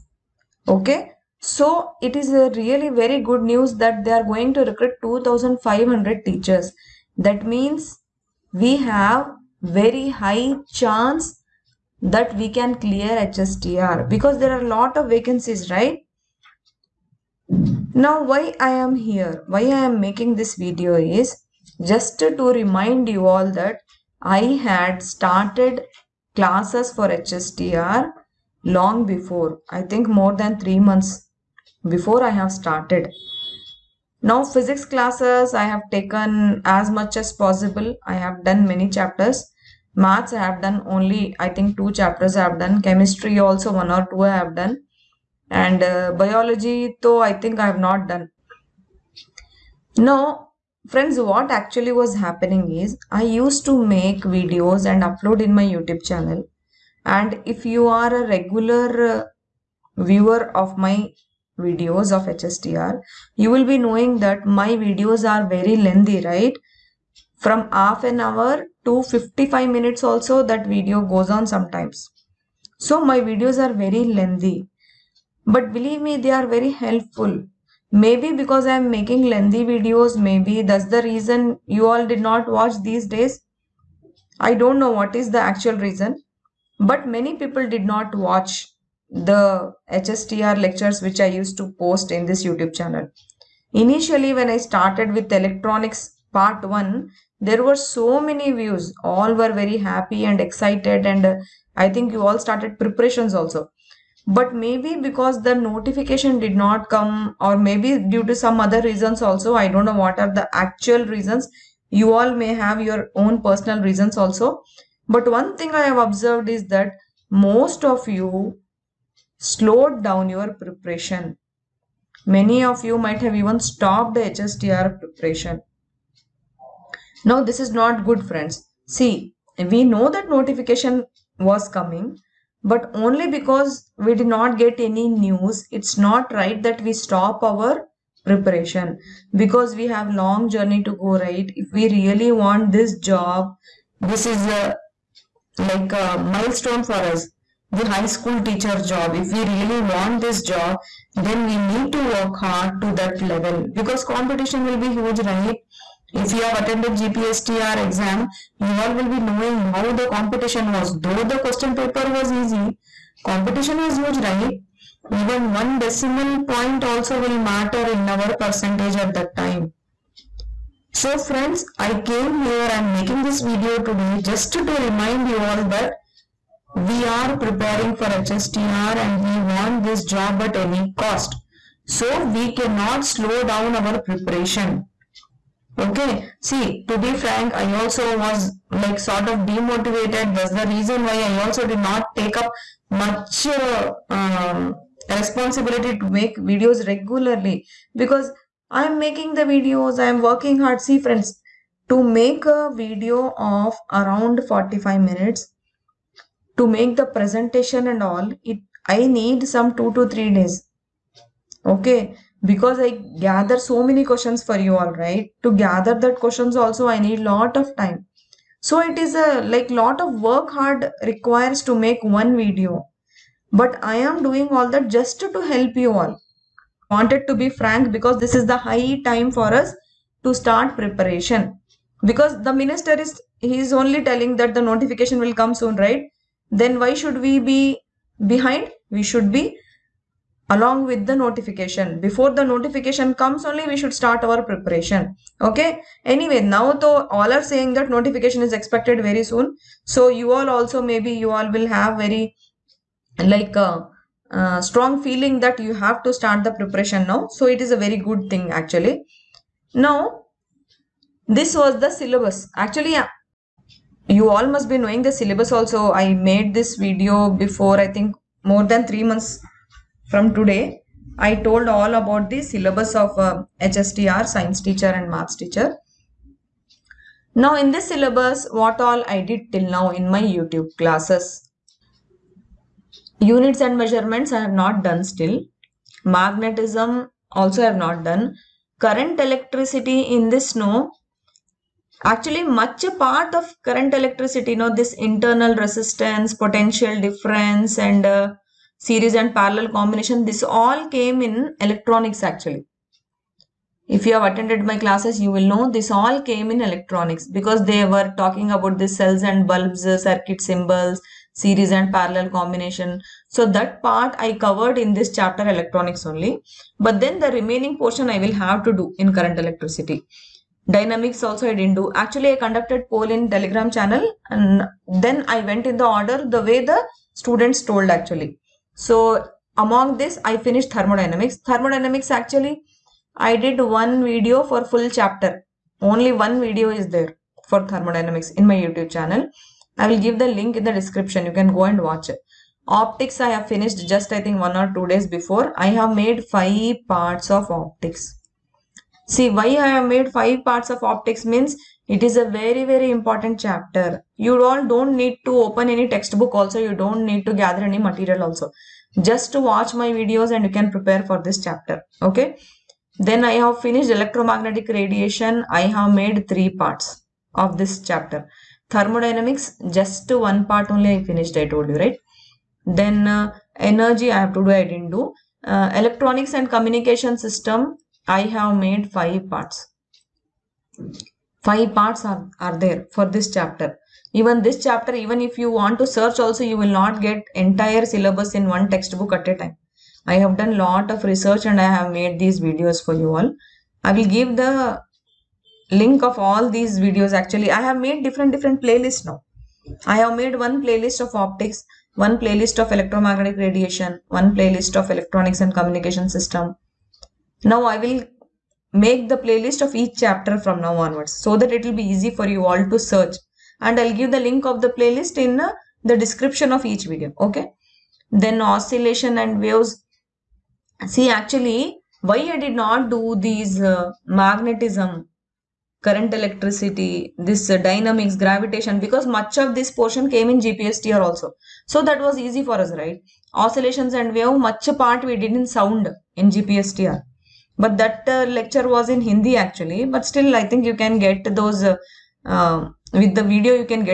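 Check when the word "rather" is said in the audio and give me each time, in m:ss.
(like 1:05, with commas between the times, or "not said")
not said.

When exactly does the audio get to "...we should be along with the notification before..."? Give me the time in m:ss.
3:58.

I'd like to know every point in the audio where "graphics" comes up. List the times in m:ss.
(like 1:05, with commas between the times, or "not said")
not said.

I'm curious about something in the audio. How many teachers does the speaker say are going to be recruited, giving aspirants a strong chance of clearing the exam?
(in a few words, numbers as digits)
2500.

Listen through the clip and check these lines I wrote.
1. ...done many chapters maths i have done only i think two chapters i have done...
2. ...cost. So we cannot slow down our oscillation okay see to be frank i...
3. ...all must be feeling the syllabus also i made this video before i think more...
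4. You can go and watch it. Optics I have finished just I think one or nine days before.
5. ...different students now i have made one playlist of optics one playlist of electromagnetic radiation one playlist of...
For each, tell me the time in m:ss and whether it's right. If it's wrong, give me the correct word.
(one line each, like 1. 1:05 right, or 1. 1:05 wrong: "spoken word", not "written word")
1. 0:38 right
2. 3:00 wrong: "preparation", not "oscillation"
3. 4:24 wrong: "knowing", not "feeling"
4. 5:41 wrong: "two", not "nine"
5. 6:38 wrong: "playlists", not "students".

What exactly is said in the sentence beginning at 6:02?
Then I have finished electromagnetic radiation.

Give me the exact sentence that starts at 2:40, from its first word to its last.
Though the question paper was easy, competition was huge, right?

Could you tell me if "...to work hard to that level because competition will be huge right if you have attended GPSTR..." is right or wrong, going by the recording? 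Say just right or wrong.
right.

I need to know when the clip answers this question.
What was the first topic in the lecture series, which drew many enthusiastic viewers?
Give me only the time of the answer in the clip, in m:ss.
1:35.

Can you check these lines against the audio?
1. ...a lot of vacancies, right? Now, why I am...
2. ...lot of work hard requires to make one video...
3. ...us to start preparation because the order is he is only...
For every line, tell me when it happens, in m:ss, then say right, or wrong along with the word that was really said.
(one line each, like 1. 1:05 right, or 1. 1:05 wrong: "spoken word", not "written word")
1. 0:14 right
2. 3:39 right
3. 3:49 wrong: "minister", not "order".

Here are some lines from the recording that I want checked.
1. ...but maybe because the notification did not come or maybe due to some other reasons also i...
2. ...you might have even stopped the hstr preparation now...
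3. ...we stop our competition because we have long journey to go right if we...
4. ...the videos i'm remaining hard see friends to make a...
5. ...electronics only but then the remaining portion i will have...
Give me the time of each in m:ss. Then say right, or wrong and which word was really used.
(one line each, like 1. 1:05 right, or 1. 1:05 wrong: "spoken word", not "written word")
1. 1:44 right
2. 2:02 right
3. 2:16 wrong: "preparation", not "competition"
4. 3:19 wrong: "working", not "remaining"
5. 5:15 right.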